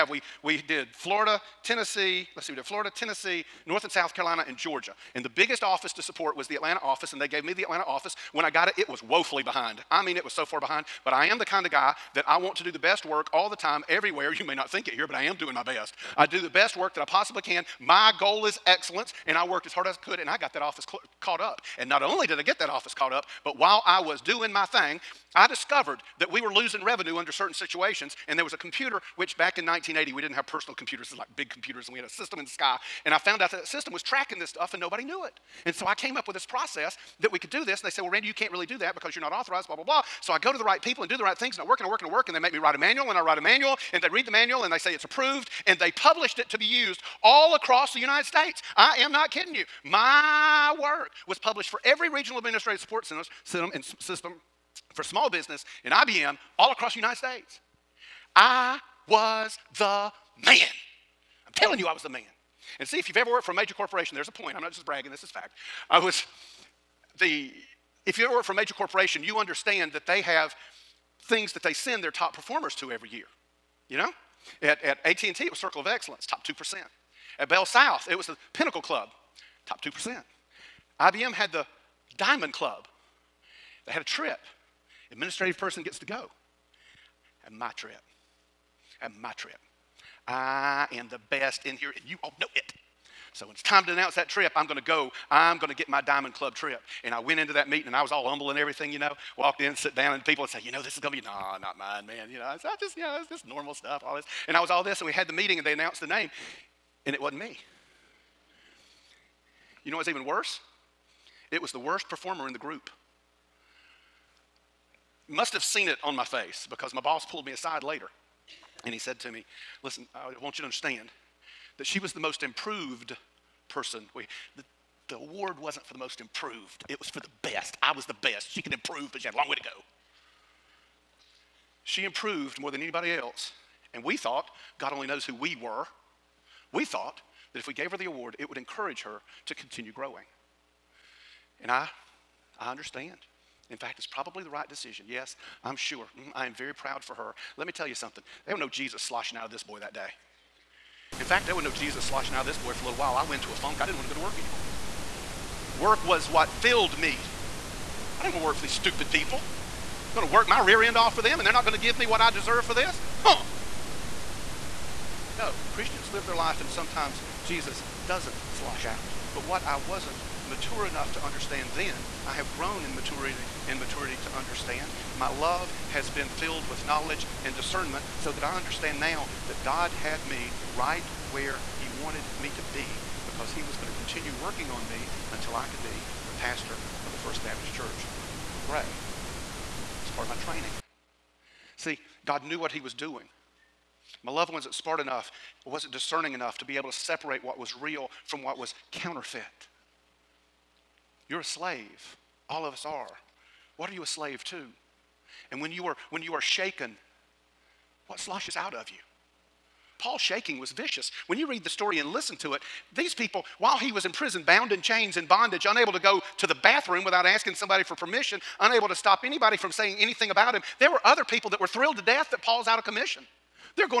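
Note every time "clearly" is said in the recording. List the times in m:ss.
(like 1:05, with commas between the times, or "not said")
not said.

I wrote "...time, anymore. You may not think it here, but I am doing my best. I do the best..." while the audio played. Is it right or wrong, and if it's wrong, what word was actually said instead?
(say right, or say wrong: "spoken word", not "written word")
wrong: "everywhere", not "anymore".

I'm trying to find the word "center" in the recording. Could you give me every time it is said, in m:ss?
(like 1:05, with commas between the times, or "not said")
not said.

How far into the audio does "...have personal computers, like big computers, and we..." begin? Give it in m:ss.
0:30.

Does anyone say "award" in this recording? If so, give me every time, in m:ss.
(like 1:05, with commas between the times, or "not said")
2:05, 2:18.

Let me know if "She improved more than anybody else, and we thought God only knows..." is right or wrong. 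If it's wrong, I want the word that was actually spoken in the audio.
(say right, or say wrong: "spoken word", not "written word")
right.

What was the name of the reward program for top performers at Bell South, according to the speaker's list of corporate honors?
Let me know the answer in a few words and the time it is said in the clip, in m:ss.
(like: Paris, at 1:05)
Pinnacle Club, at 1:18.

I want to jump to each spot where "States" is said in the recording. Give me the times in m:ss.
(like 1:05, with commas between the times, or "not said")
0:48, 0:57.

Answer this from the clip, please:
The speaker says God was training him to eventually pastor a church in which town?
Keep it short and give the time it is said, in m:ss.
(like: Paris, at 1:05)
Gray, at 3:07.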